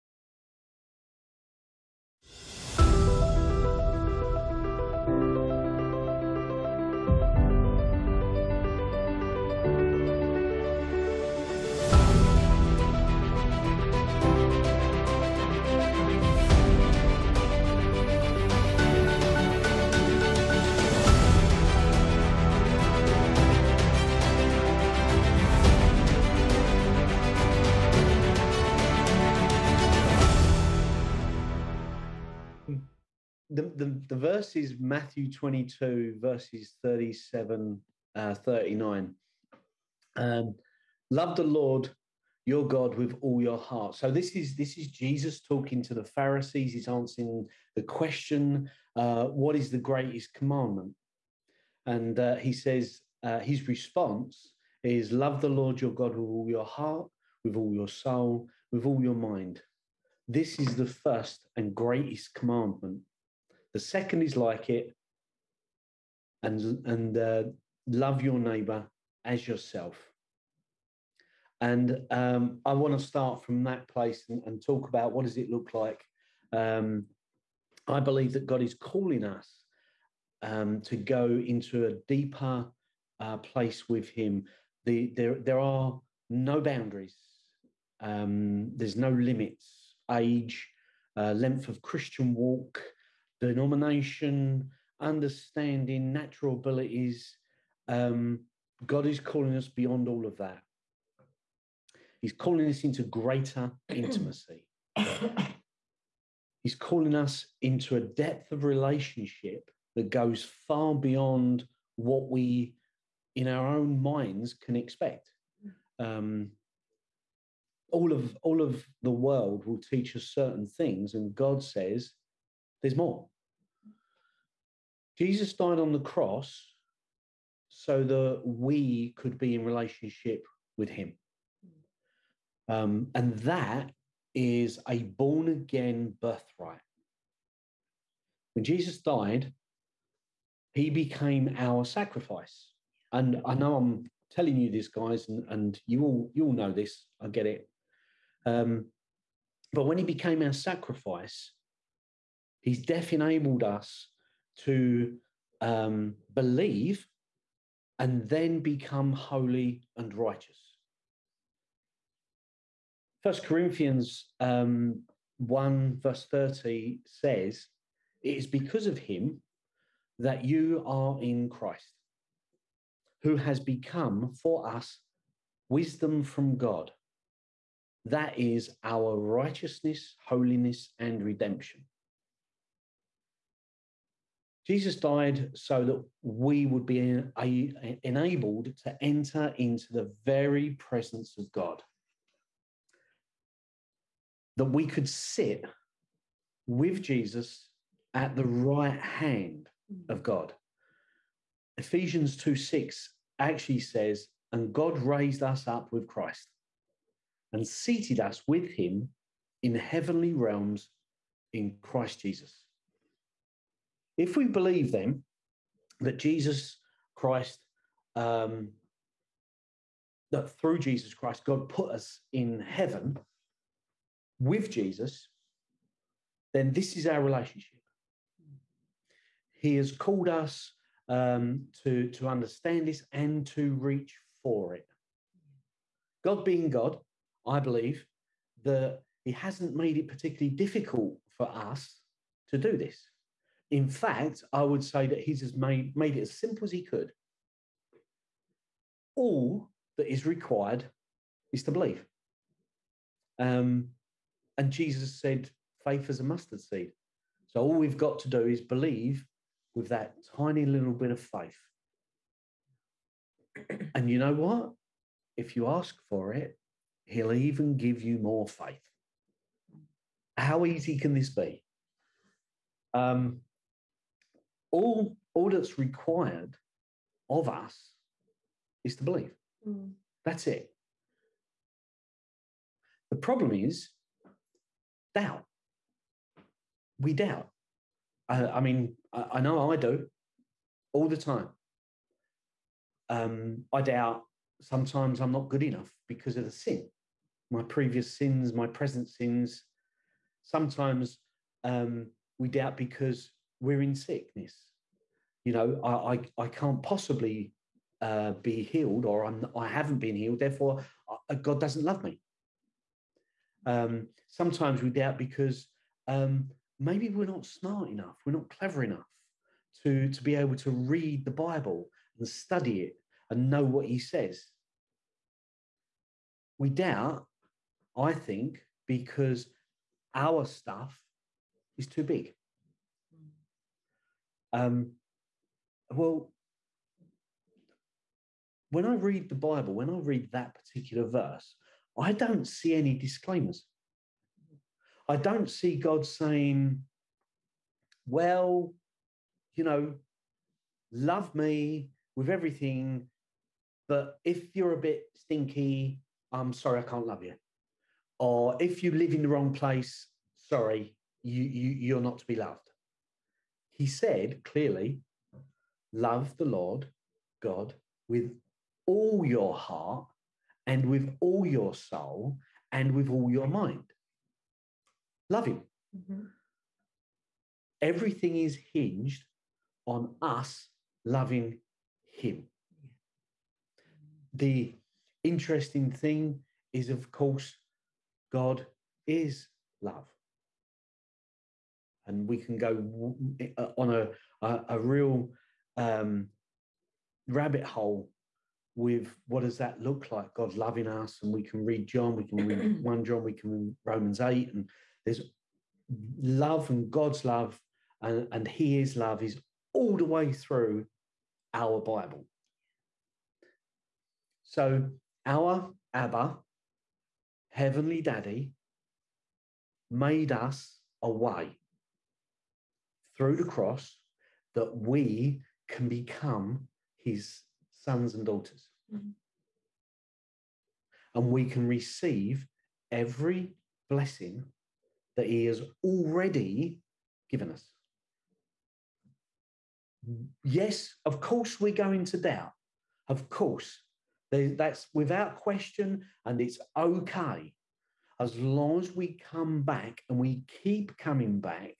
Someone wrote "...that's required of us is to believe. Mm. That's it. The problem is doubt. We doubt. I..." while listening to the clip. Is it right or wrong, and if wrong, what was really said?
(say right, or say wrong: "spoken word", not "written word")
right.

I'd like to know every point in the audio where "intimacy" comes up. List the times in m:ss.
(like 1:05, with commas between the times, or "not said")
1:43.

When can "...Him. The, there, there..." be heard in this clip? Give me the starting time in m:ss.
1:24.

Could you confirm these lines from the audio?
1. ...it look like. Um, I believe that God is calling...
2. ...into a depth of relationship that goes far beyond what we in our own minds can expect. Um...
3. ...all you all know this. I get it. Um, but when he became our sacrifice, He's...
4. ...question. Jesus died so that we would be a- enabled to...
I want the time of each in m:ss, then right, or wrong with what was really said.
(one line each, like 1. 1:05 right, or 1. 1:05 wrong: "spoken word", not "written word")
1. 1:15 right
2. 1:47 right
3. 2:26 right
4. 3:01 wrong: "redemption", not "question".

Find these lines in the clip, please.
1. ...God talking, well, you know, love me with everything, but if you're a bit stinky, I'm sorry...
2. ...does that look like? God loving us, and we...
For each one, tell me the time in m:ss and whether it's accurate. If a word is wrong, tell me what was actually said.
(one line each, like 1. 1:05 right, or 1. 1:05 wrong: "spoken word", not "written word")
1. 5:45 wrong: "saying", not "talking"
2. 6:39 right.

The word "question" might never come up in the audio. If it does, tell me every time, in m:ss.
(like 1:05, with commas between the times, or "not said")
0:47, 7:25.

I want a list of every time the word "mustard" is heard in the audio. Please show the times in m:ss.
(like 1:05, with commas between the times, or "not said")
4:16.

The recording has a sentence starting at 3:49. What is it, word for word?
He has called us um, to, to understand this and to reach for it.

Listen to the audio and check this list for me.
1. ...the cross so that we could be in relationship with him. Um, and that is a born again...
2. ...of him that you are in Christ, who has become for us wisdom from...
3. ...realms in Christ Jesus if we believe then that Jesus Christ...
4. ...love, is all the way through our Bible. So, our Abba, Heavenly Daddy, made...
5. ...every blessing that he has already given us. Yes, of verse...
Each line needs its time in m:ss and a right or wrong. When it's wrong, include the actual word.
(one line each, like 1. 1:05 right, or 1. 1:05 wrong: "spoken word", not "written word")
1. 2:05 right
2. 2:48 right
3. 3:30 right
4. 6:48 right
5. 7:12 wrong: "course", not "verse".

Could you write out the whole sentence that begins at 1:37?
Um, God is calling us beyond all of that.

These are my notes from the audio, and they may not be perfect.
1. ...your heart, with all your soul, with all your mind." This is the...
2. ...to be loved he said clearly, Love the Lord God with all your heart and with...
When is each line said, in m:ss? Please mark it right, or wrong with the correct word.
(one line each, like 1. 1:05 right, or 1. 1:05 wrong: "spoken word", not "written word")
1. 0:56 right
2. 6:02 right.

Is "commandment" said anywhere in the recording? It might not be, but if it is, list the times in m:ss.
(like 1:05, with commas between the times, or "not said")
0:50, 1:02.